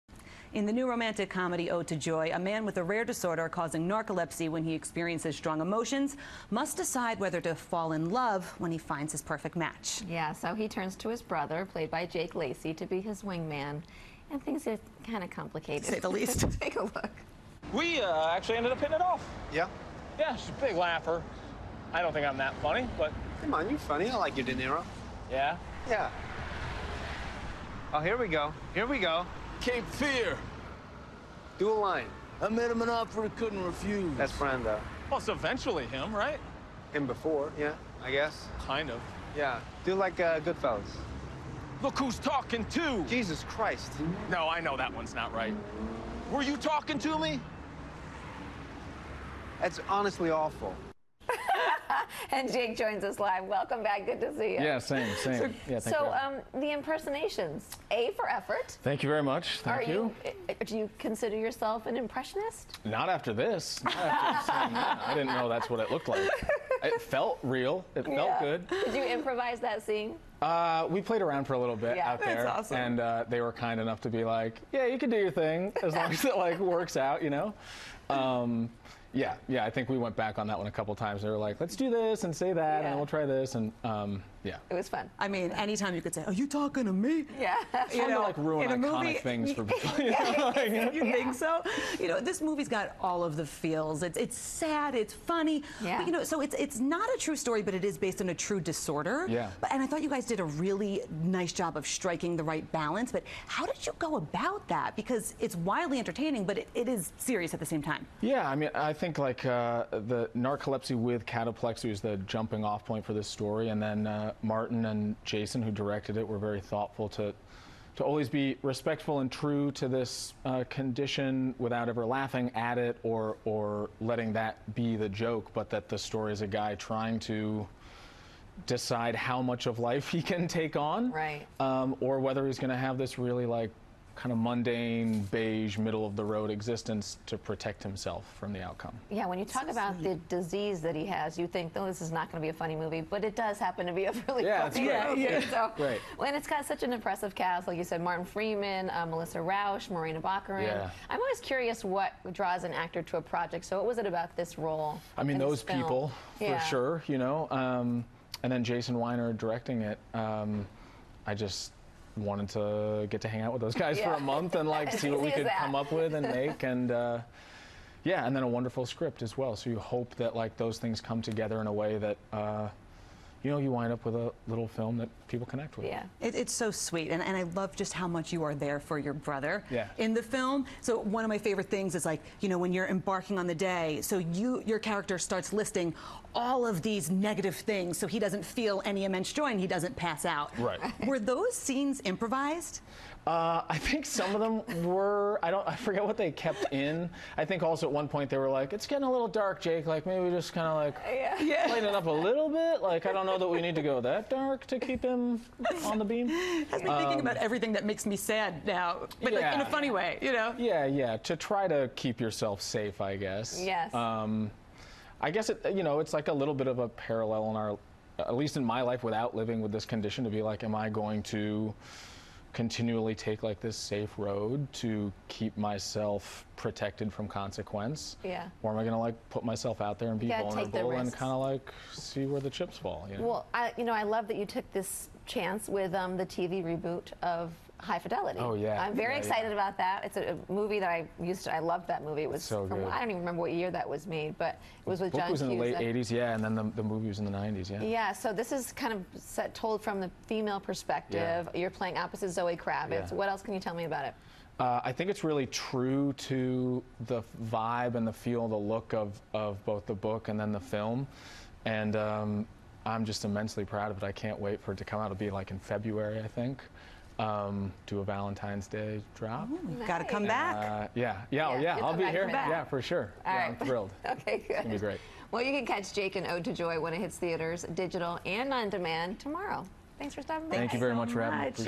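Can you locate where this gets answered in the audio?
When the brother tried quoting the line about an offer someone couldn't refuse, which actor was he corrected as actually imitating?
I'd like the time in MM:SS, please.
00:34.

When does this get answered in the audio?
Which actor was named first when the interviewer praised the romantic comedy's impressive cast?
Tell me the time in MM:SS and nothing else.
02:28.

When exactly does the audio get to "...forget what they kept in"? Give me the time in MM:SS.
03:15.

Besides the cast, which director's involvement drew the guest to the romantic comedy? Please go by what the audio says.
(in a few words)
Jason Winer.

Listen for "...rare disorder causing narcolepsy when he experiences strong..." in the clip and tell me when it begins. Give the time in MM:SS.
00:02.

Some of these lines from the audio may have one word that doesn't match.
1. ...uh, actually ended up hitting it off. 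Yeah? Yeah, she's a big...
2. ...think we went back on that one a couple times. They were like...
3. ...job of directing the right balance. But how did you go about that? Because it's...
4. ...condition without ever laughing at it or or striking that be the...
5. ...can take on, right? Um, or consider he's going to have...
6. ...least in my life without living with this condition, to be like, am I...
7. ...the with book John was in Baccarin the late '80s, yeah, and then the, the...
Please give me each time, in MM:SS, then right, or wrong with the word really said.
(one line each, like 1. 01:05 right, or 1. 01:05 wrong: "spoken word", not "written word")
1. 00:18 right
2. 01:19 right
3. 01:41 wrong: "striking", not "directing"
4. 02:00 wrong: "letting", not "striking"
5. 02:10 wrong: "whether", not "consider"
6. 03:38 right
7. 04:04 wrong: "Hughes", not "Baccarin".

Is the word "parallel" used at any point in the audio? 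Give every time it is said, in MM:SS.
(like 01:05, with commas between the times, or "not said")
03:36.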